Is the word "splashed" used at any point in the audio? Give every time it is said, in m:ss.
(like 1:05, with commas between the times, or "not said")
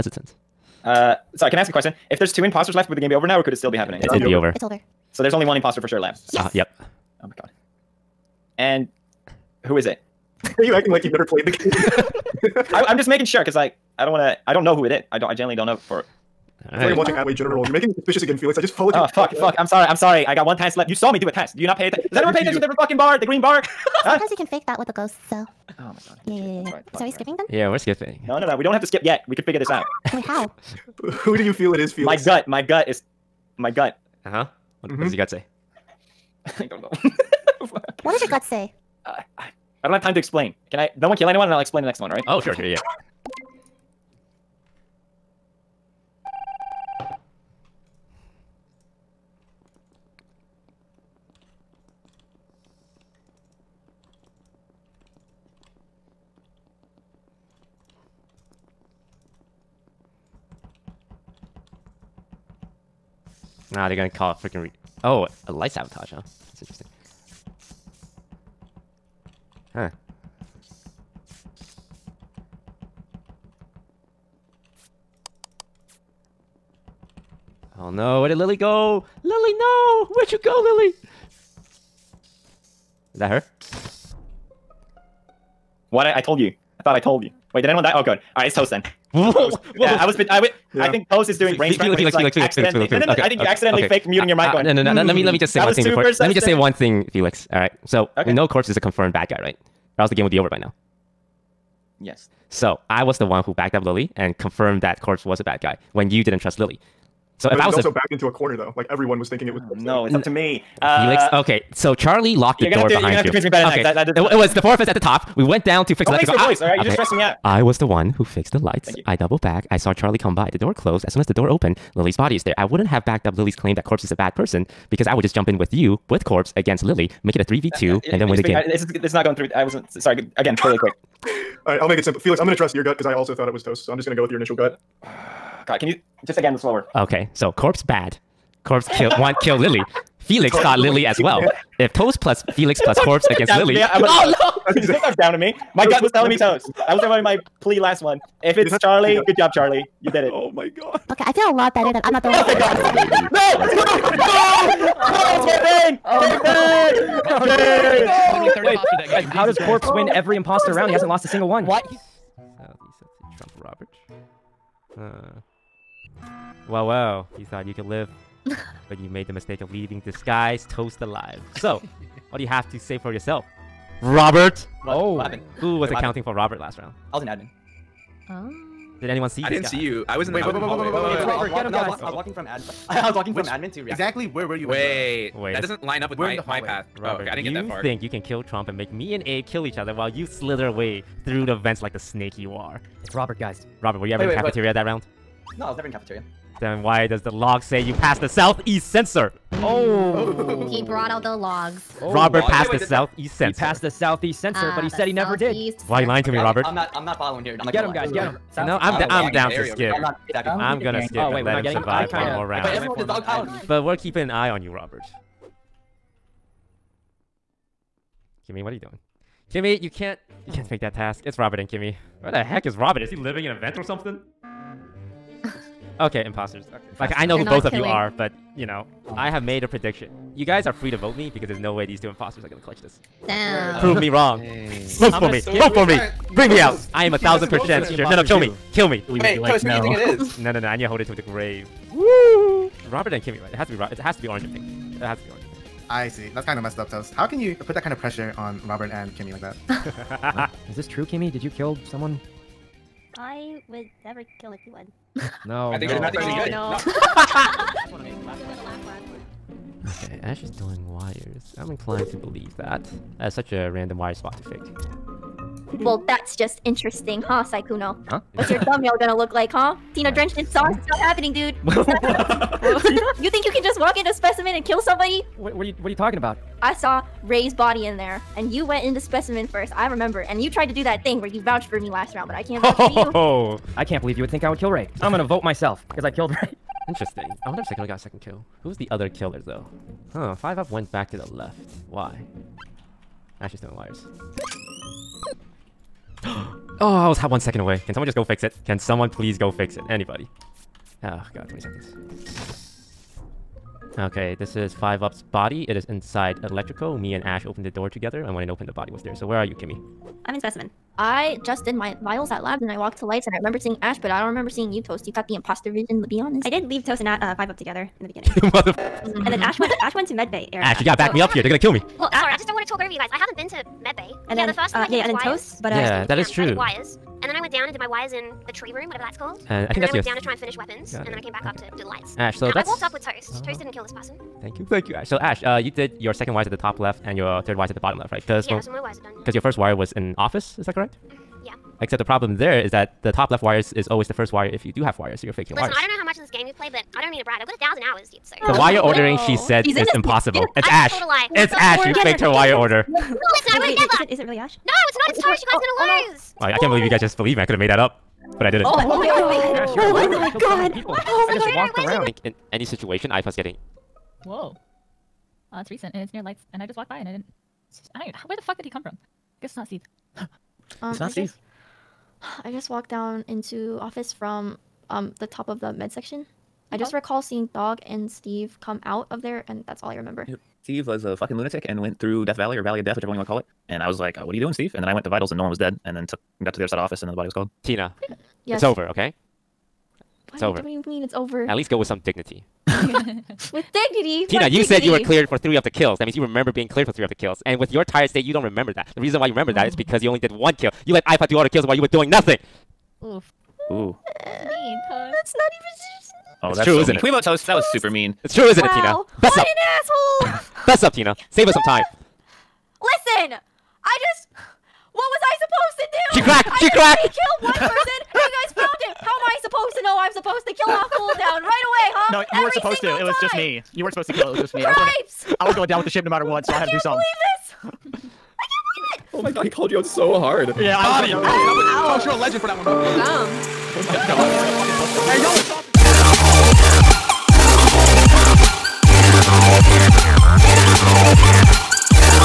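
not said.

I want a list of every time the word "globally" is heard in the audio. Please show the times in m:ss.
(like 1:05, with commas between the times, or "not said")
not said.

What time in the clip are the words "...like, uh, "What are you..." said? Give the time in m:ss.
6:23.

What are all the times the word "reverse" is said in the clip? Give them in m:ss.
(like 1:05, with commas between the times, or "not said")
not said.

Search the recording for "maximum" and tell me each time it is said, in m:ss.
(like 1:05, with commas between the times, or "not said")
not said.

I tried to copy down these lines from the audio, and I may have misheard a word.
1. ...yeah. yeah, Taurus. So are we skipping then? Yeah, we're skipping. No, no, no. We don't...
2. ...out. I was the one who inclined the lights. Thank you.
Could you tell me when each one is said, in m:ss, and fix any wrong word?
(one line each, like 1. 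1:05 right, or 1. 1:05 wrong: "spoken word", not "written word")
1. 0:26 wrong: "Right", not "Taurus"
2. 1:57 wrong: "fixed", not "inclined".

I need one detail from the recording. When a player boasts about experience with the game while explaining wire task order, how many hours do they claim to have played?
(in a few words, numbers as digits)
1000 hours.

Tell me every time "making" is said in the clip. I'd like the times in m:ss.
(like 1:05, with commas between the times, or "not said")
0:13, 0:17.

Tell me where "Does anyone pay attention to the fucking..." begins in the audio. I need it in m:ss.
0:22.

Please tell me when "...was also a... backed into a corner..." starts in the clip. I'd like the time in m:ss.
1:47.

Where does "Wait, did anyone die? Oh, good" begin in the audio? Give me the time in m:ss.
1:27.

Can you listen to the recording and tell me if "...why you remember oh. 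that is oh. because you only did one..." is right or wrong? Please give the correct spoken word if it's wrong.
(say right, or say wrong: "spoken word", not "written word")
right.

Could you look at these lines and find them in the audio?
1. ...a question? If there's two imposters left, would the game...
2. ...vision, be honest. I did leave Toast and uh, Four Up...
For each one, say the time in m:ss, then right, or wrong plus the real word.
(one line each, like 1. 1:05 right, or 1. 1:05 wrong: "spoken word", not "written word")
1. 0:01 right
2. 5:15 wrong: "Five", not "Four".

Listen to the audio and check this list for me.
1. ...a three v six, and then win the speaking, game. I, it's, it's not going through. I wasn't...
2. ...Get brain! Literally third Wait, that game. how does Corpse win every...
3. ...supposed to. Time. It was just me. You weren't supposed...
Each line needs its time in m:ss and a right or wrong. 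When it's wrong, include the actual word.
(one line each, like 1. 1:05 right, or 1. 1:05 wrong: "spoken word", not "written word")
1. 2:07 wrong: "two", not "six"
2. 2:37 right
3. 7:02 right.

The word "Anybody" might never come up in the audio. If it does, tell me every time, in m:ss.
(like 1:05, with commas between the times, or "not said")
4:59.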